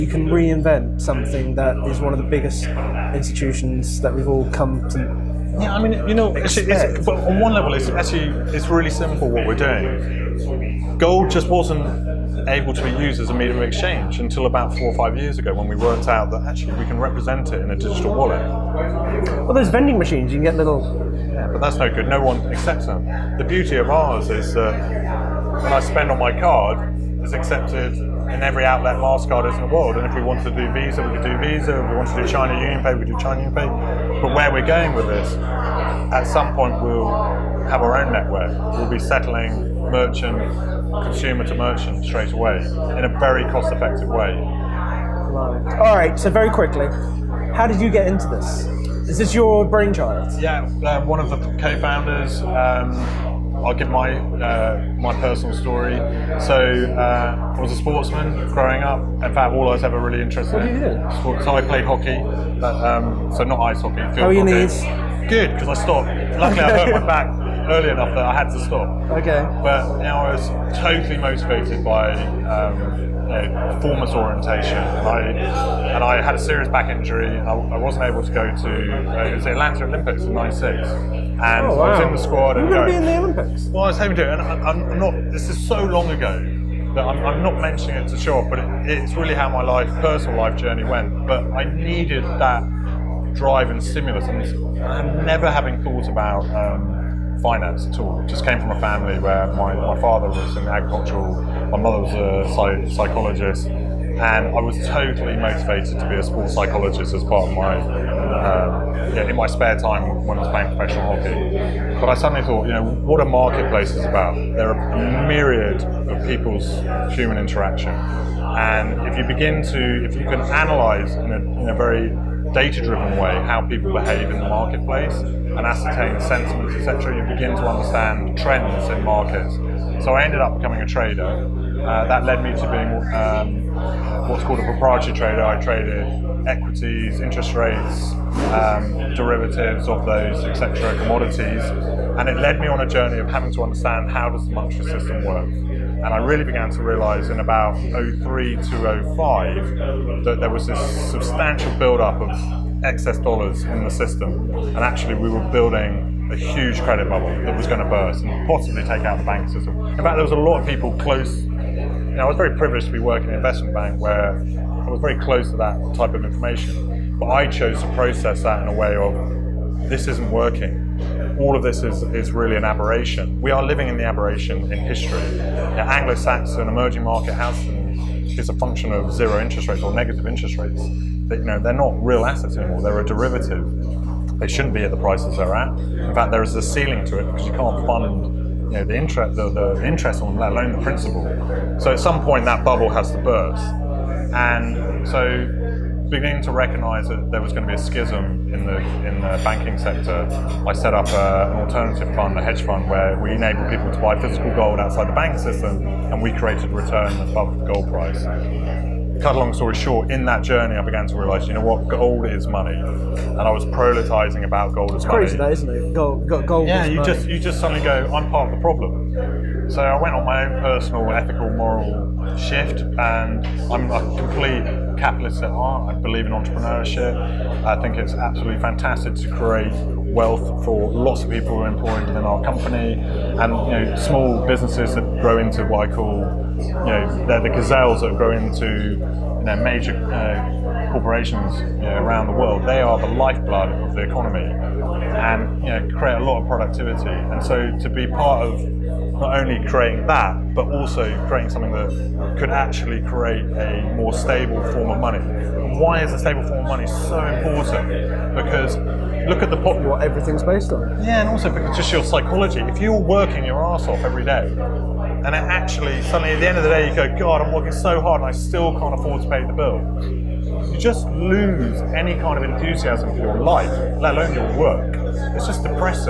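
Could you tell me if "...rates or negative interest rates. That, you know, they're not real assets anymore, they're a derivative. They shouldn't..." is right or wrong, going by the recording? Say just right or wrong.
right.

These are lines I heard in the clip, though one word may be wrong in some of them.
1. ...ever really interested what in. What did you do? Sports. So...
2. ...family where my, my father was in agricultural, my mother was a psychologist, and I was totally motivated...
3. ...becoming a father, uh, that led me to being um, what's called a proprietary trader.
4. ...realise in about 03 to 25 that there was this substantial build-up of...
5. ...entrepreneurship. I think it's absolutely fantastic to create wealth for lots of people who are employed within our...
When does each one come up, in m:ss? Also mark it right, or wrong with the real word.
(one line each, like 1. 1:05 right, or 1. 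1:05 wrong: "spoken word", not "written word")
1. 0:59 right
2. 1:38 right
3. 2:10 wrong: "trader", not "father"
4. 2:26 wrong: "05", not "25"
5. 3:46 right.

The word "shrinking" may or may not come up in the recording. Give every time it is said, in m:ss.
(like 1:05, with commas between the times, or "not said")
not said.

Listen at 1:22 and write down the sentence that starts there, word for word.
You're going to be in the Olympics.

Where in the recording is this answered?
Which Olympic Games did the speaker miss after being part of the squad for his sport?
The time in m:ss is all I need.
1:19.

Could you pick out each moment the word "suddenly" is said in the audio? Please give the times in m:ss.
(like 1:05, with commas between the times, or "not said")
1:52, 3:37, 4:26.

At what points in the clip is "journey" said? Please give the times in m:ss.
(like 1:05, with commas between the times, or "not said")
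1:30, 2:22, 3:30.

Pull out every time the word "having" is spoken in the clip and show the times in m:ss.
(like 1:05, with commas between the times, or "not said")
1:35, 2:23.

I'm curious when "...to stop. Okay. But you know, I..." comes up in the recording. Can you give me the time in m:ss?
1:08.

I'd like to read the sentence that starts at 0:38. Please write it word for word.
We'll be settling merchant, consumer to merchant straight away in a very cost effective way.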